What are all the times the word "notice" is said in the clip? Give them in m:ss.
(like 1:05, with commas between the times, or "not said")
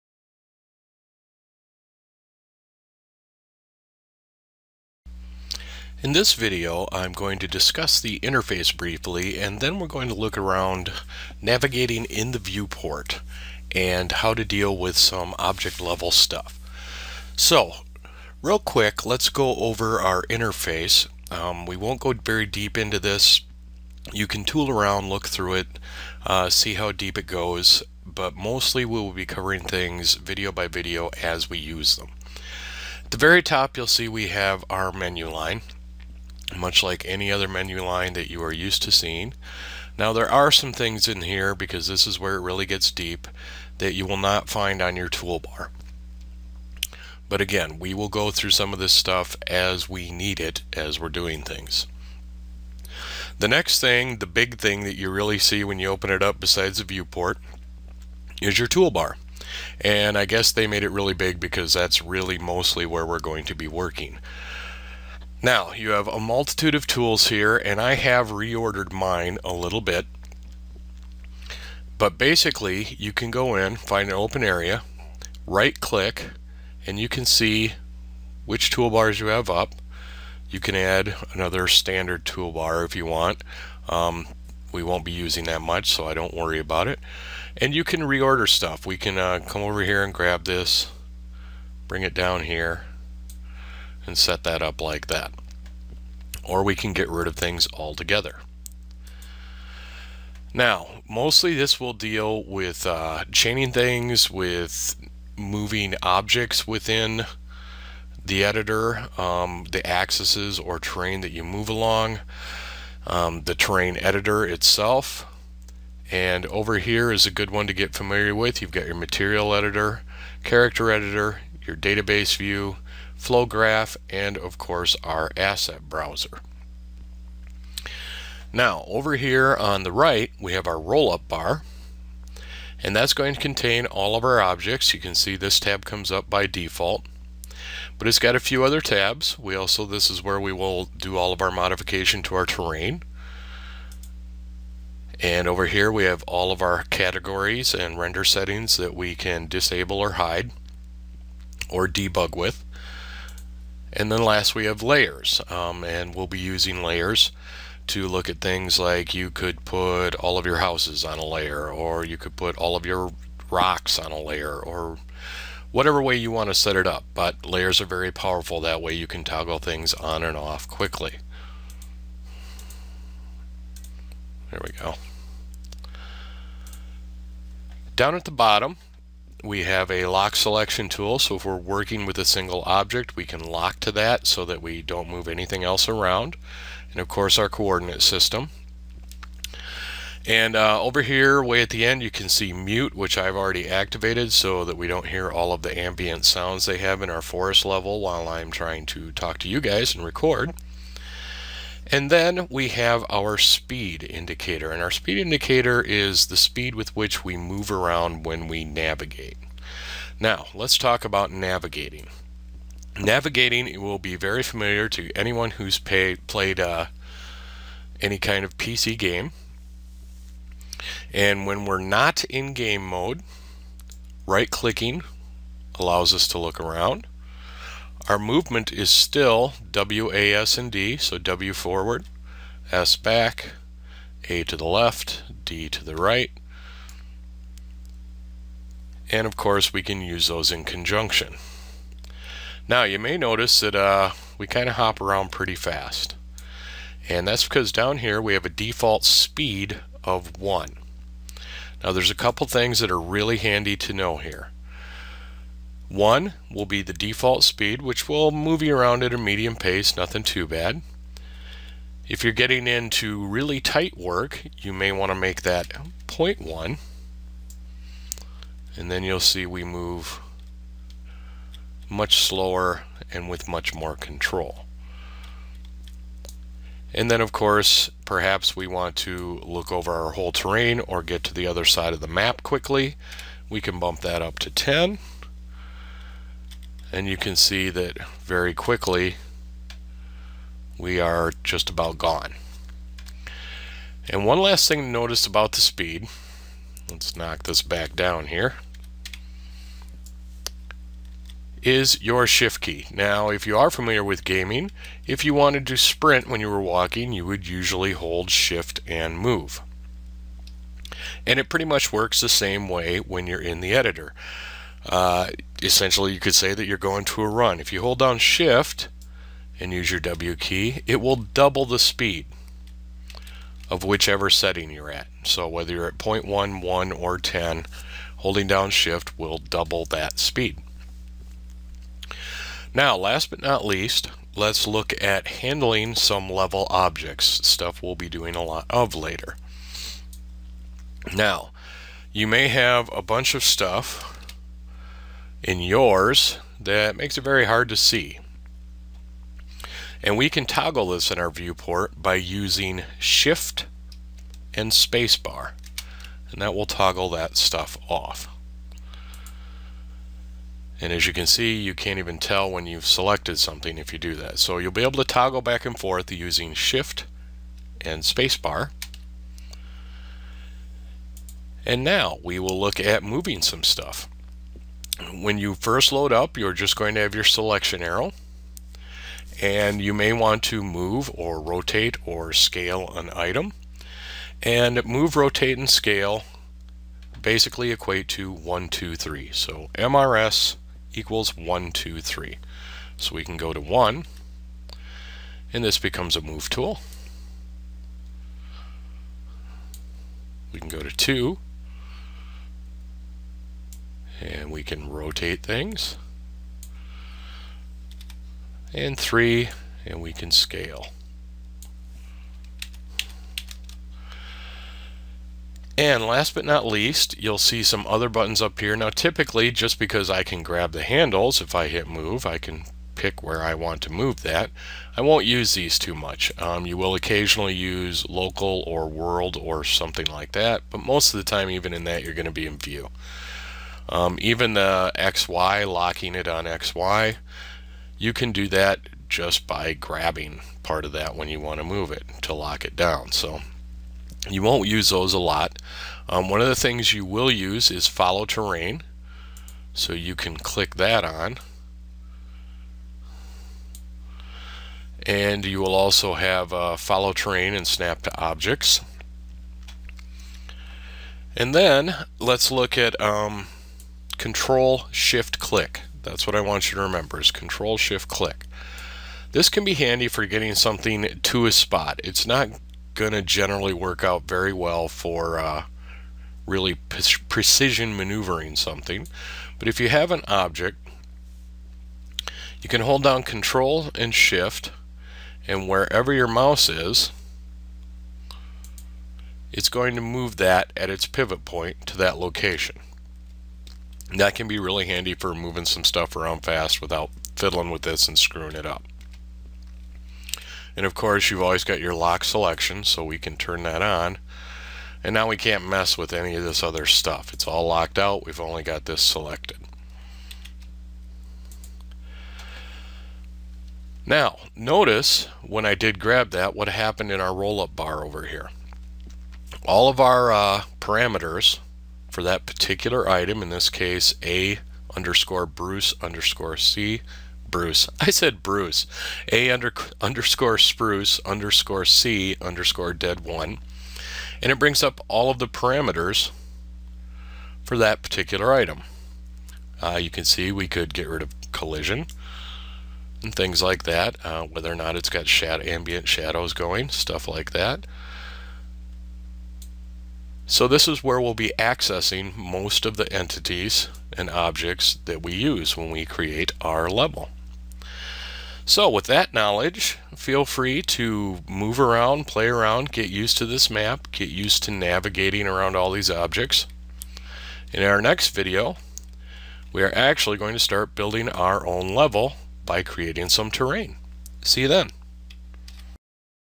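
4:03, 4:54, 8:34.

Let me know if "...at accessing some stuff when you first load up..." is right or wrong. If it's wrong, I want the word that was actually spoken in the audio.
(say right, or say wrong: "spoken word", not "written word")
wrong: "moving", not "accessing".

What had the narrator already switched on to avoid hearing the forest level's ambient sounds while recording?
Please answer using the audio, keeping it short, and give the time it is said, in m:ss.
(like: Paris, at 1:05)
mute, at 3:12.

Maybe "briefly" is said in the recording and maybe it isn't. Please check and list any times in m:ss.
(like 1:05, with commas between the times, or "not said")
0:08.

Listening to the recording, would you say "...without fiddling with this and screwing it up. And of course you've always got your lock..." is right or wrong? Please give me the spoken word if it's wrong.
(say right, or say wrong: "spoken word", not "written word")
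right.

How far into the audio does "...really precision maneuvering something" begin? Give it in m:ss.
7:56.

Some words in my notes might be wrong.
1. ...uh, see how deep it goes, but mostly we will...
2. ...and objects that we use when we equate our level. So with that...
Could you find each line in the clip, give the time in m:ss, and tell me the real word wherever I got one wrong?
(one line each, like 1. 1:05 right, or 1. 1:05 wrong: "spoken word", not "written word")
1. 0:26 right
2. 9:14 wrong: "create", not "equate".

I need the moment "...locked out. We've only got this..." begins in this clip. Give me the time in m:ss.
8:27.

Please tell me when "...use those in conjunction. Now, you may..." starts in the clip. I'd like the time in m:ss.
4:00.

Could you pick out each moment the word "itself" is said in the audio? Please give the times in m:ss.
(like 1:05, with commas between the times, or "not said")
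1:54.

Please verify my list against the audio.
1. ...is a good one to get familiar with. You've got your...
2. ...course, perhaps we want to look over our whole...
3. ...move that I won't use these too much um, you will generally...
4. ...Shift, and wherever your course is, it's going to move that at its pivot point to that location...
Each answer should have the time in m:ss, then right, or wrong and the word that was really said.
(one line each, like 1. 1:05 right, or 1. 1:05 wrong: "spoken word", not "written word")
1. 1:57 right
2. 4:37 right
3. 7:03 wrong: "occasionally", not "generally"
4. 8:04 wrong: "mouse", not "course".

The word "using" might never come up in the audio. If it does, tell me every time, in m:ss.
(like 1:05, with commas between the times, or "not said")
1:25, 2:36, 5:52, 6:06.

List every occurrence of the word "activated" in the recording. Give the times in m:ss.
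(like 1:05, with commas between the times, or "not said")
3:13.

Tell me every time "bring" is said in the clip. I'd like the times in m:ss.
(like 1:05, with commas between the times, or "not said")
1:31, 8:54.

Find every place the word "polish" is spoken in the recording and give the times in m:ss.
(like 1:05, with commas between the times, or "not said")
not said.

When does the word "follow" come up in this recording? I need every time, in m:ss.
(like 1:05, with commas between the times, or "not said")
7:27, 7:36.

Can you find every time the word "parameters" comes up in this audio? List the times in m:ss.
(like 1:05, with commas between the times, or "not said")
8:40, 8:55.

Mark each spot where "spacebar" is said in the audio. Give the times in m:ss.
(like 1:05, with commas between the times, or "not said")
5:54, 6:08.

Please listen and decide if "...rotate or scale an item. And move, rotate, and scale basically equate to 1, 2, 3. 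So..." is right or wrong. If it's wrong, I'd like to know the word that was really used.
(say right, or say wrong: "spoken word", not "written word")
right.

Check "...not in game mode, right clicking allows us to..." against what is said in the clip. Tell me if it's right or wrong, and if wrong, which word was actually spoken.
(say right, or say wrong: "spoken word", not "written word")
right.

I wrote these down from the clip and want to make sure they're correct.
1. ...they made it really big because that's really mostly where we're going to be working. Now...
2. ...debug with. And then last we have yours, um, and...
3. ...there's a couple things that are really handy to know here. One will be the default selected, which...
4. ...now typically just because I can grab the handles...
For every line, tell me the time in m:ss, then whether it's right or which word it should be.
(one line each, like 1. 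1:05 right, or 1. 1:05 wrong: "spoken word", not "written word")
1. 1:00 right
2. 2:31 wrong: "layers", not "yours"
3. 4:11 wrong: "speed", not "selected"
4. 6:58 right.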